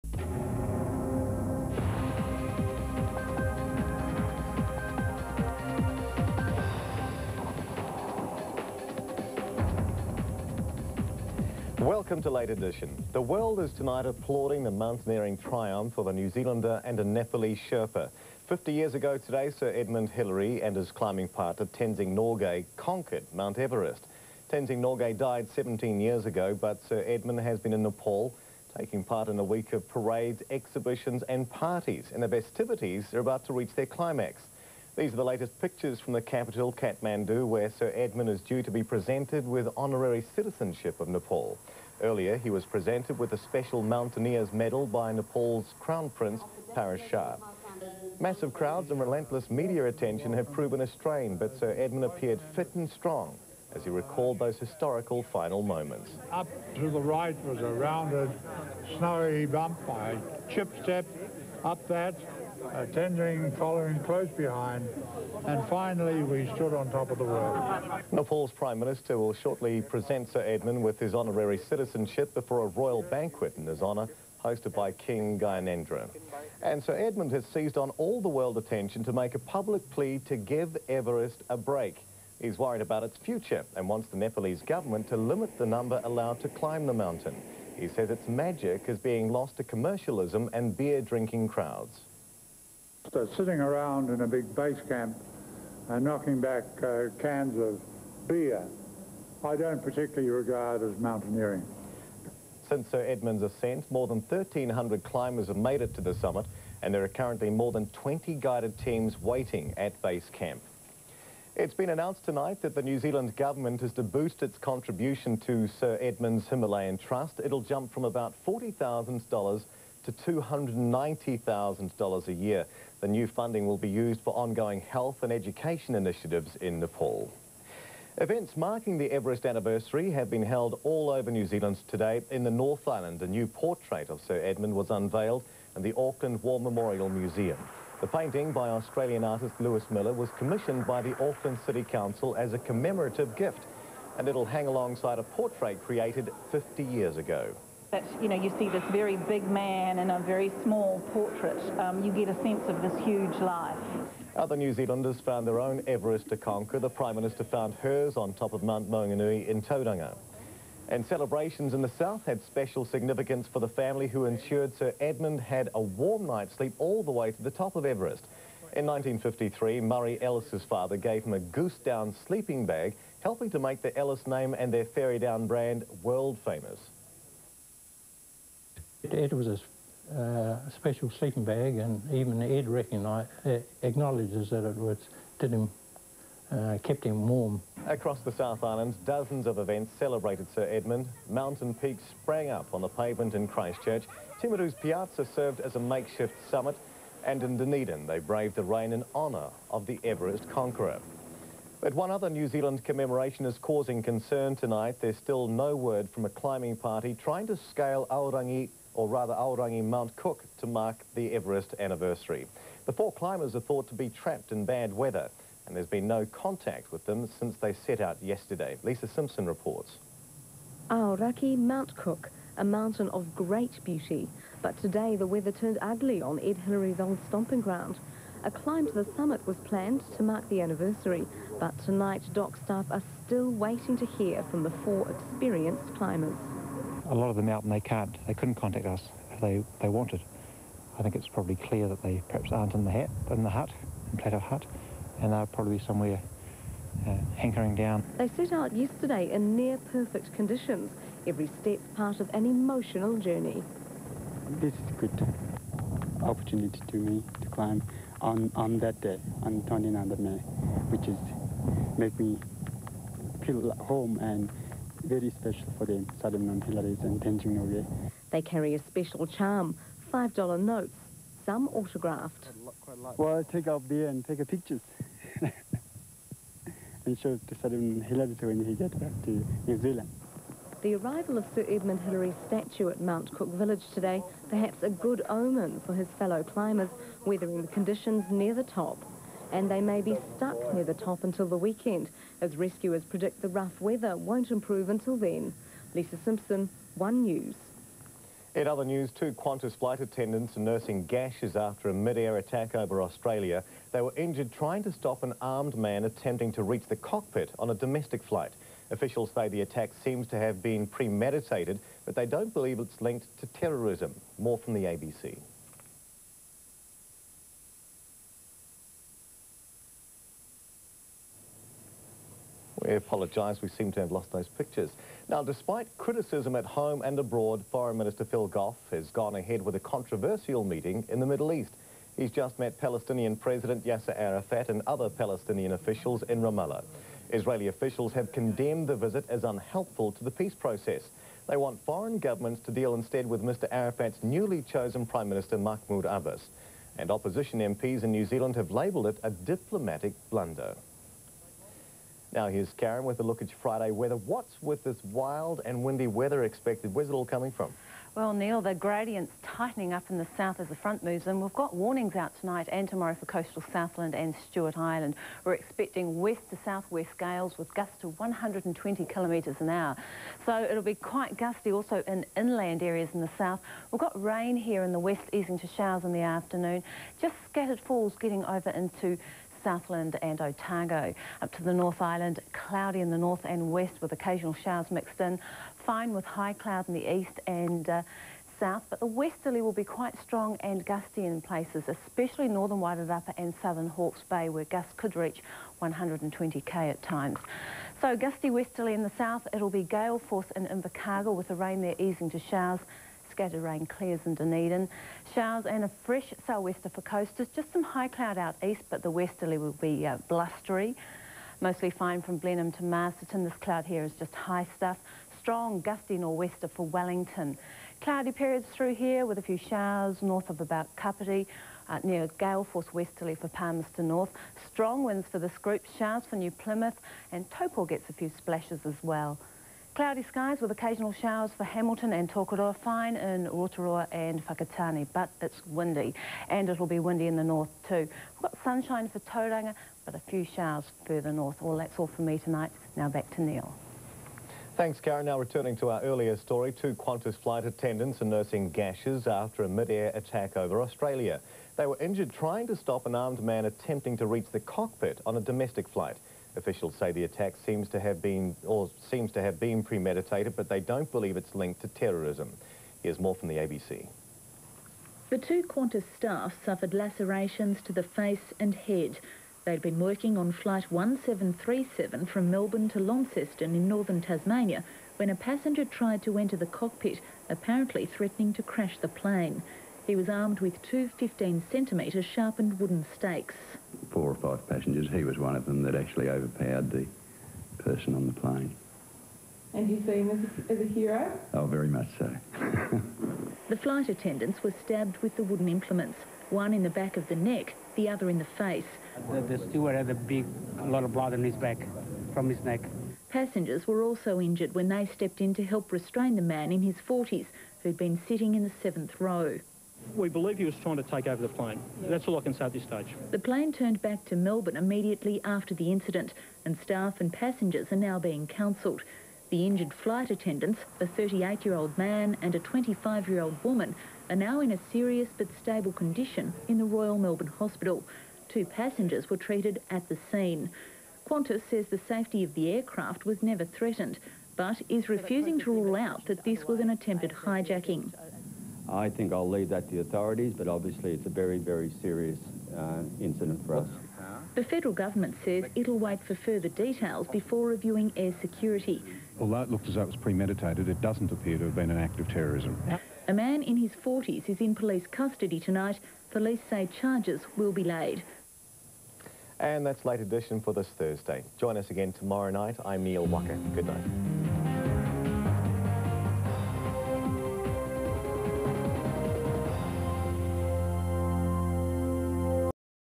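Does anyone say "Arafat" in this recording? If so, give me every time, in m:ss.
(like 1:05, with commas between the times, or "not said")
5:34, 5:43.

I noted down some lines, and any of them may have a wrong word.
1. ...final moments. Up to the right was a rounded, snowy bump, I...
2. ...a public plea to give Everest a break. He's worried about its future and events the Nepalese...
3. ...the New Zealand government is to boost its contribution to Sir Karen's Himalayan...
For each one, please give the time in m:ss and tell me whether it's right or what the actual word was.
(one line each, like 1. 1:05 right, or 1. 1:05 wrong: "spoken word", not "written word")
1. 0:55 right
2. 1:19 wrong: "wants", not "events"
3. 1:52 wrong: "Edmund", not "Karen".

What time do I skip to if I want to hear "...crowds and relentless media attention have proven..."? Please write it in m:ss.
0:48.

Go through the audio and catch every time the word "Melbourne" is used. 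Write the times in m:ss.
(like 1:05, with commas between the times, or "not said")
7:52, 8:34, 8:47.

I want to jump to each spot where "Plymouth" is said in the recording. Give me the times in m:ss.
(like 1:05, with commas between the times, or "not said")
7:06.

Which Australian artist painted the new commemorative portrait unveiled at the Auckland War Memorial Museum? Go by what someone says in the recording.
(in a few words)
Lewis Miller.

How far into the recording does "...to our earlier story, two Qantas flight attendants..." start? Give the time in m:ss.
7:25.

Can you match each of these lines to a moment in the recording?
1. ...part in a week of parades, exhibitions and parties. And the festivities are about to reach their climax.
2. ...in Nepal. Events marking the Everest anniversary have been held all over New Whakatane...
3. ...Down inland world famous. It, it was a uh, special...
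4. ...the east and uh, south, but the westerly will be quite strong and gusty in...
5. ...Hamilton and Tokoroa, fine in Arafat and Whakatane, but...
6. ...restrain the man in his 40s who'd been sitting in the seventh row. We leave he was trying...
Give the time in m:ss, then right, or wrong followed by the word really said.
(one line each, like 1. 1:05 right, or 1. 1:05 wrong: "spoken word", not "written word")
1. 0:29 right
2. 2:06 wrong: "Zealand", not "Whakatane"
3. 2:55 wrong: "brand", not "inland"
4. 6:26 right
5. 7:11 wrong: "Rotorua", not "Arafat"
6. 8:25 wrong: "believe", not "leave".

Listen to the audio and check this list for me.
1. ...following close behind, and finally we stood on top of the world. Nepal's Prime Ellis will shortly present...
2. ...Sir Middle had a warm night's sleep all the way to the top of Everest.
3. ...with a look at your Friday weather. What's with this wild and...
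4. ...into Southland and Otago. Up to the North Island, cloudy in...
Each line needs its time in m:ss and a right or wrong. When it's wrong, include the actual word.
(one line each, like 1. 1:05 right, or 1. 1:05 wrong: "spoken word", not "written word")
1. 1:03 wrong: "Minister", not "Ellis"
2. 2:44 wrong: "Edmund", not "Middle"
3. 5:53 right
4. 6:18 right.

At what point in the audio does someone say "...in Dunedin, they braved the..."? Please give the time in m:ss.
3:17.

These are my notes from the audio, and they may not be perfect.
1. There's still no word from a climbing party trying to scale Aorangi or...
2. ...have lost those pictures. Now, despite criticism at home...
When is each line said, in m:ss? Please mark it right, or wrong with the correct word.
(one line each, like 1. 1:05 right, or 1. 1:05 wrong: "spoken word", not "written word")
1. 3:25 right
2. 5:24 right.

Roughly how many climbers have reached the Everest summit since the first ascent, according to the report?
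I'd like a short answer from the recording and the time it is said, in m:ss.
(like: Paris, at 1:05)
more than 1,300, at 1:43.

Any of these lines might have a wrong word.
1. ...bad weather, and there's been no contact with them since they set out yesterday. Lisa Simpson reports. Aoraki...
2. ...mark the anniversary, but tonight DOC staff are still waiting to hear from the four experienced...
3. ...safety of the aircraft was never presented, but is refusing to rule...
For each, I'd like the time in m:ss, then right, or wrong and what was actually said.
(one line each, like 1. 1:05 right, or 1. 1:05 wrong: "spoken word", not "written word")
1. 3:34 right
2. 3:50 right
3. 8:52 wrong: "threatened", not "presented".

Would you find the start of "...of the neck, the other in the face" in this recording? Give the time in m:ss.
8:17.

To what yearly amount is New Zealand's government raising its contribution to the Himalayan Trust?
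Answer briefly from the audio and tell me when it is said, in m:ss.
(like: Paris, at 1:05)
$290,000, at 2:00.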